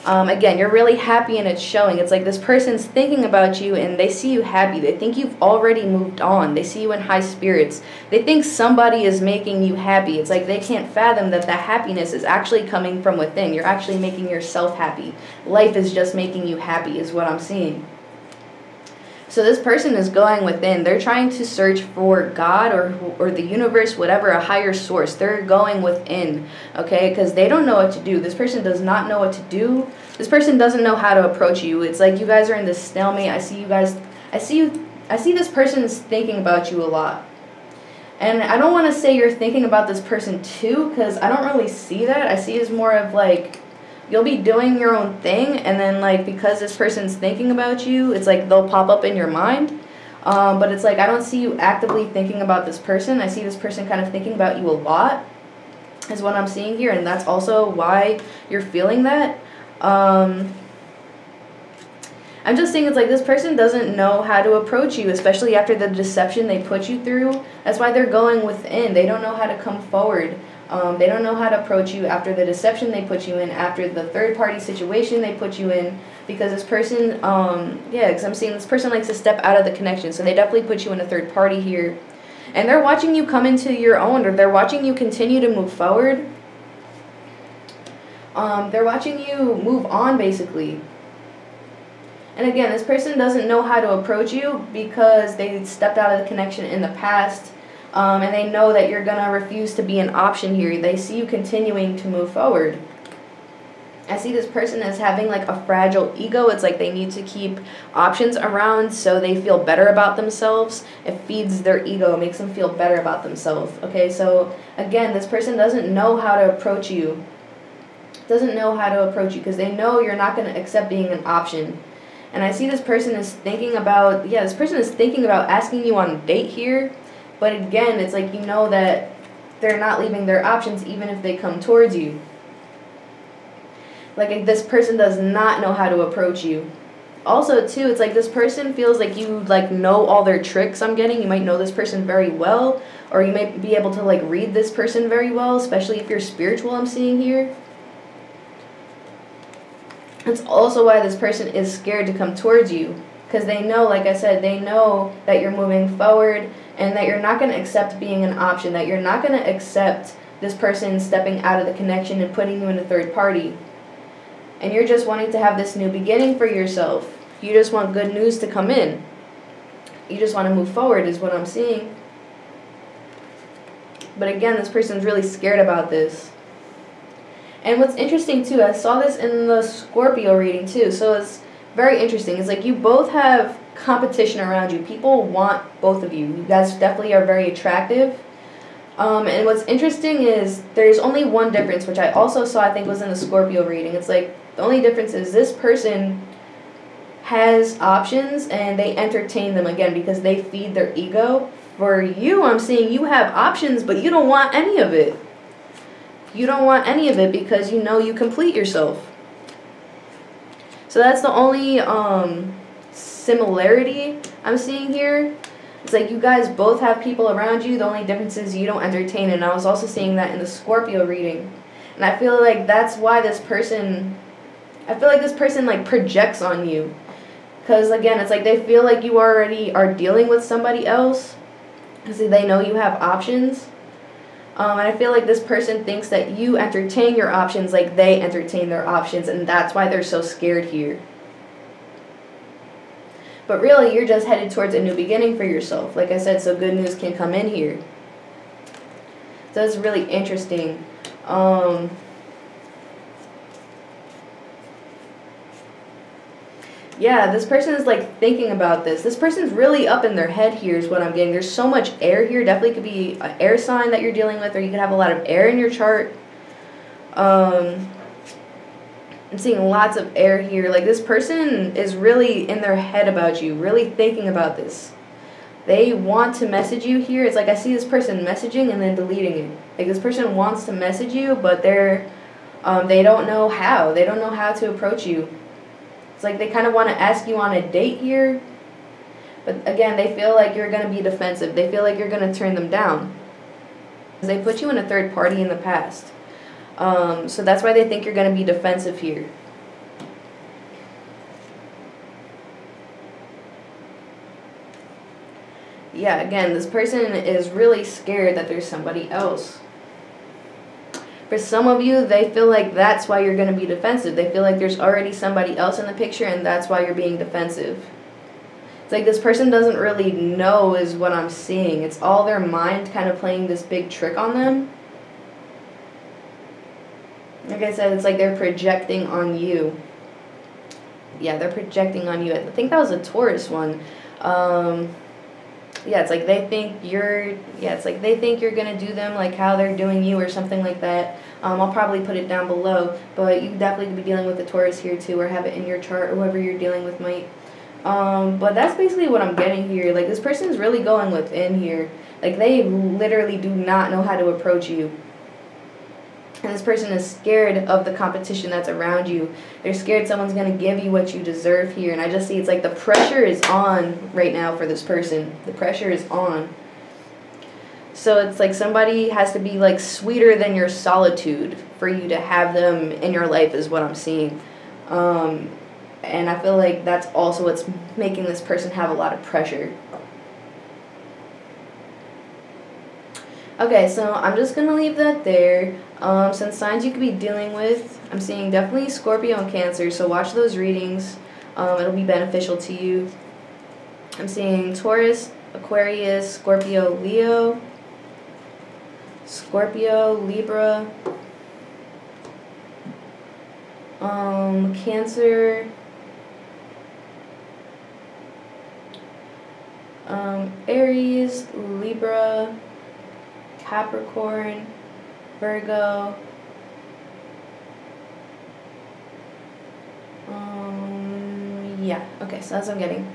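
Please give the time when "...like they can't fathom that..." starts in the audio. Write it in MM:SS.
00:10.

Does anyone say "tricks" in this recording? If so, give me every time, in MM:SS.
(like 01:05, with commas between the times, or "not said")
02:20, 05:23.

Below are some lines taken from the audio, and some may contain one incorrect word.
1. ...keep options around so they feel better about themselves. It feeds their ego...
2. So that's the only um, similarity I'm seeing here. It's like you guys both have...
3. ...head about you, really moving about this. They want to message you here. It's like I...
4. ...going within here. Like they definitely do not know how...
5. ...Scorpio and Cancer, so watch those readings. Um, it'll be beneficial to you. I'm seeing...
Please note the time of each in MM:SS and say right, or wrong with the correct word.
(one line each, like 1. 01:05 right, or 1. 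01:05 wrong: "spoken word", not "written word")
1. 01:47 right
2. 03:30 right
3. 04:32 wrong: "thinking", not "moving"
4. 05:50 wrong: "literally", not "definitely"
5. 06:28 right.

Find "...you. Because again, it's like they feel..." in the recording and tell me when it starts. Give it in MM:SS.
03:46.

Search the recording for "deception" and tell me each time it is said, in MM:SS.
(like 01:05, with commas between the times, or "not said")
01:05, 01:12.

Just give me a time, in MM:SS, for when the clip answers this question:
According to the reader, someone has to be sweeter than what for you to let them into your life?
06:10.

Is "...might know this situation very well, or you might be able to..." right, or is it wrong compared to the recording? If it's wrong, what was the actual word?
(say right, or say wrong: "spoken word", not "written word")
wrong: "person", not "situation".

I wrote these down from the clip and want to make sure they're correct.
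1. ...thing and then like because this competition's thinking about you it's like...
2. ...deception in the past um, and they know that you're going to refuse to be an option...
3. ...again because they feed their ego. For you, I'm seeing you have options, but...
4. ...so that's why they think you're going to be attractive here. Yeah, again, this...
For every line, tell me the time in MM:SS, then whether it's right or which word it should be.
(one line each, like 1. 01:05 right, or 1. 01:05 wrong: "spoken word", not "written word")
1. 00:45 wrong: "person", not "competition"
2. 01:36 wrong: "connection", not "deception"
3. 03:19 right
4. 04:57 wrong: "defensive", not "attractive".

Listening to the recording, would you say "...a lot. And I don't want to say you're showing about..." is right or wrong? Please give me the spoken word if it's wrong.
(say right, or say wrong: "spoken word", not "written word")
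wrong: "thinking", not "showing".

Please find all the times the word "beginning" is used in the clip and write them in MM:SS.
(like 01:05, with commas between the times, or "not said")
02:45, 04:04.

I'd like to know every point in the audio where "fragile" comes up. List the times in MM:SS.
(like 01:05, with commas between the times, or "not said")
01:45.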